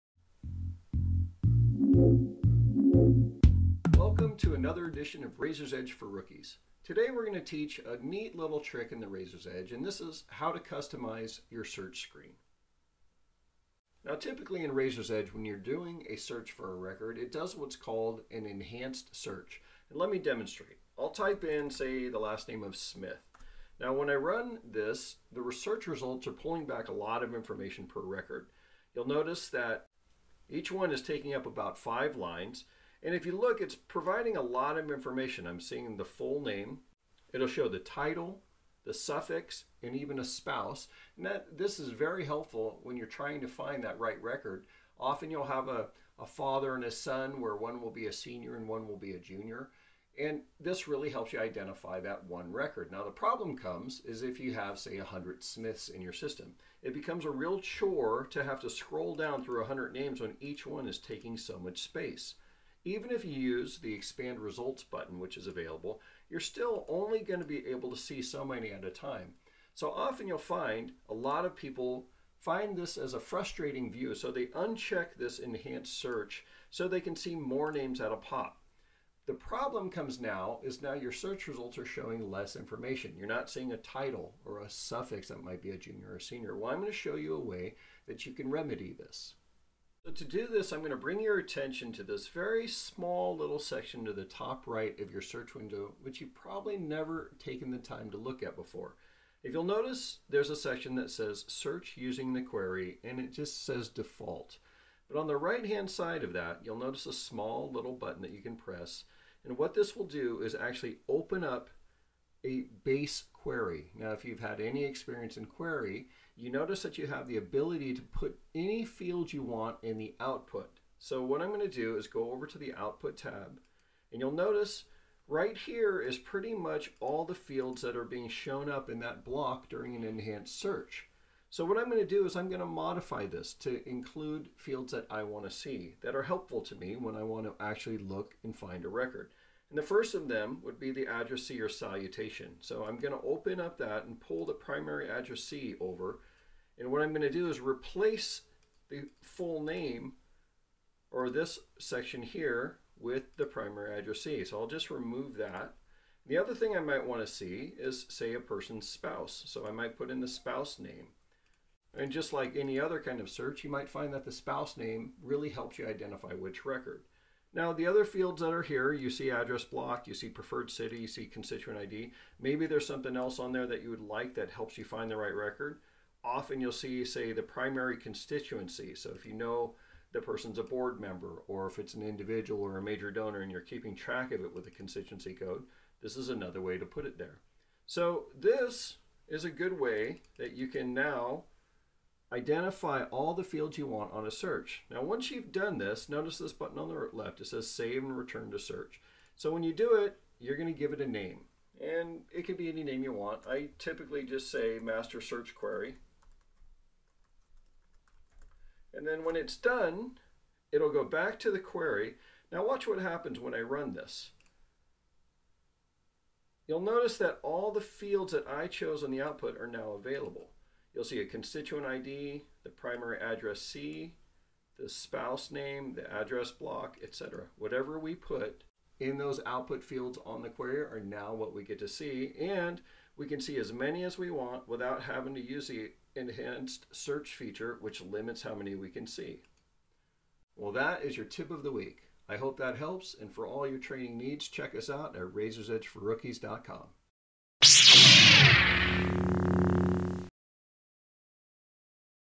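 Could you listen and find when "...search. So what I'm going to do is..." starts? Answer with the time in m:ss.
2:10.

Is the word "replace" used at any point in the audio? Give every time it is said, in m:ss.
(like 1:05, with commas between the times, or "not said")
2:27.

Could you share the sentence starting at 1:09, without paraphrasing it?
So often you'll find a lot of people find this as a frustrating view.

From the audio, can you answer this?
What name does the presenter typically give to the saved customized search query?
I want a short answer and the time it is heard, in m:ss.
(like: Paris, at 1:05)
master search query, at 3:24.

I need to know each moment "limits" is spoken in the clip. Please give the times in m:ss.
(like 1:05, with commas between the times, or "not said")
3:58.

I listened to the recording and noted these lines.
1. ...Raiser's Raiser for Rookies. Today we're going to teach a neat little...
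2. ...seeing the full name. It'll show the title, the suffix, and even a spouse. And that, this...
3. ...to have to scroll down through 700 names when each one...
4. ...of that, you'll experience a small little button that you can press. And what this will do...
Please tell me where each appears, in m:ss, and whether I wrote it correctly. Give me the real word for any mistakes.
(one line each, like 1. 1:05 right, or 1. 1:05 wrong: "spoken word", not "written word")
1. 0:05 wrong: "Edge", not "Raiser"
2. 0:35 right
3. 0:58 wrong: "100", not "700"
4. 1:46 wrong: "notice", not "experience".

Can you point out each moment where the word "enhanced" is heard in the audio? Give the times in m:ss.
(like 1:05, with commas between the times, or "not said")
0:18, 1:15, 2:10, 3:56.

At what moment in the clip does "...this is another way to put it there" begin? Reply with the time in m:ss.
3:06.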